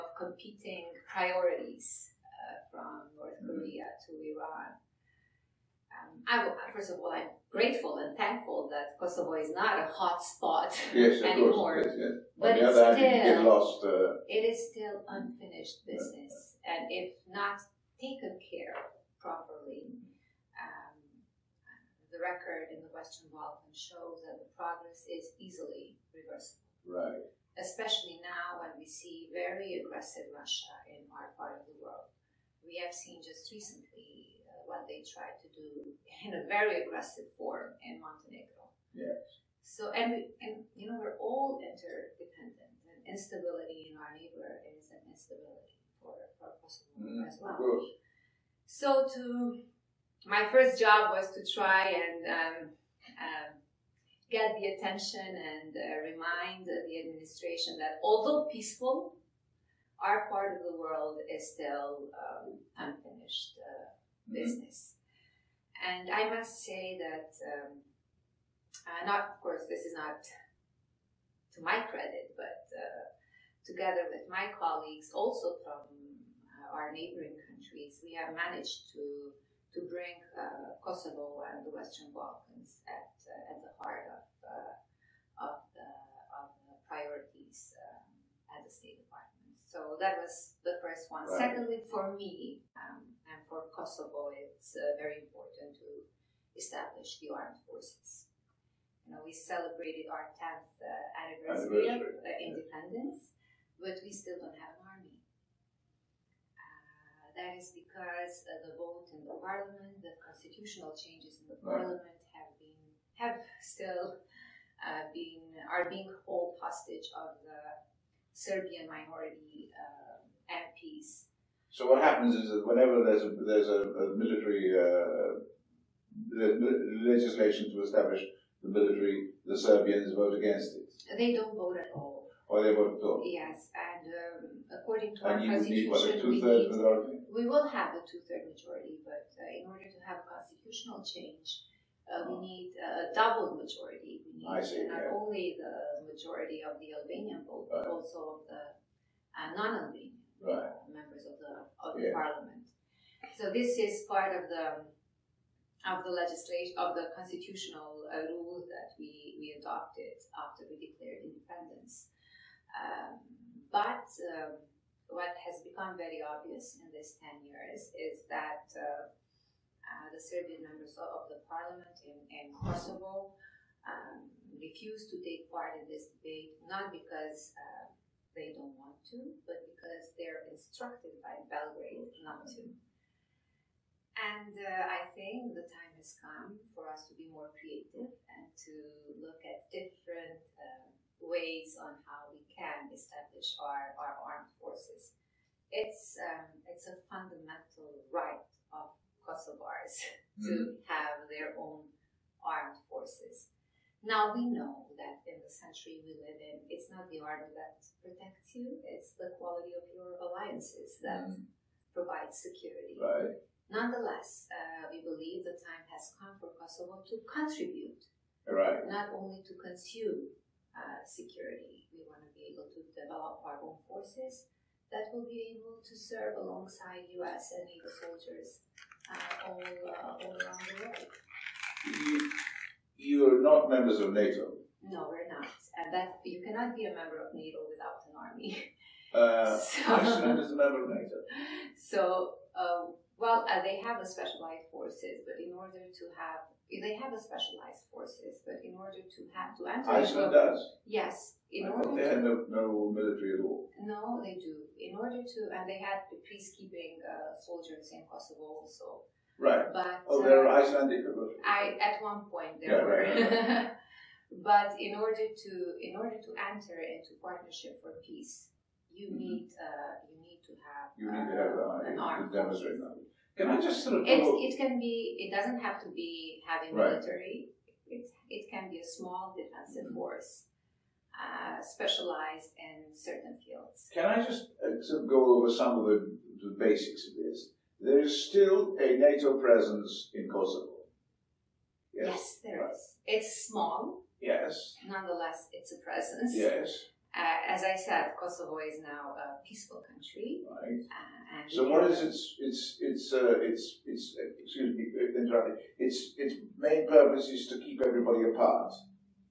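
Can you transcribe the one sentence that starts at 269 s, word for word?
need uh, you need to have you need uh, to have an army to demonstrate that.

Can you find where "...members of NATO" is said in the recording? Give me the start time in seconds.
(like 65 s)
233 s.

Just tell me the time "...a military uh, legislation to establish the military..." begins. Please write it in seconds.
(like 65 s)
123 s.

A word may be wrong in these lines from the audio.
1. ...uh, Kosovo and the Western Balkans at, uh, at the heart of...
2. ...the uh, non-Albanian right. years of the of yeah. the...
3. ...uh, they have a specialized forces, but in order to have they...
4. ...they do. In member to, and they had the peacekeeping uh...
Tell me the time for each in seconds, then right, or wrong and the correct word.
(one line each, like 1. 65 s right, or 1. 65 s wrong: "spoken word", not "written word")
1. 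80 s right
2. 148 s wrong: "members", not "years"
3. 243 s right
4. 254 s wrong: "order", not "member".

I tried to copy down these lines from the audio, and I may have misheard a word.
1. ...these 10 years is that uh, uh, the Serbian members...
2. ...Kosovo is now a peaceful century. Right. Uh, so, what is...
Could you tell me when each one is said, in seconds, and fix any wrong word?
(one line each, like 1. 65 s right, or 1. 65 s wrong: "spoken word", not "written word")
1. 166 s right
2. 298 s wrong: "country", not "century".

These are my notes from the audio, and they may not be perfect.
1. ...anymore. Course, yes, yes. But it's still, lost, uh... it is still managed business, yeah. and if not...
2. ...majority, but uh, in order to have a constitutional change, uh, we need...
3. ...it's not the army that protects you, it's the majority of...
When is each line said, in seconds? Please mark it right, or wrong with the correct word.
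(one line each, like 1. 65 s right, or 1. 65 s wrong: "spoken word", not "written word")
1. 11 s wrong: "unfinished", not "managed"
2. 138 s right
3. 206 s wrong: "quality", not "majority".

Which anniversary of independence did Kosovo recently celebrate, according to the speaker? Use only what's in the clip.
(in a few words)
10th.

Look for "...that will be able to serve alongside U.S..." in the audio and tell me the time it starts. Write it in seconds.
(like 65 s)
224 s.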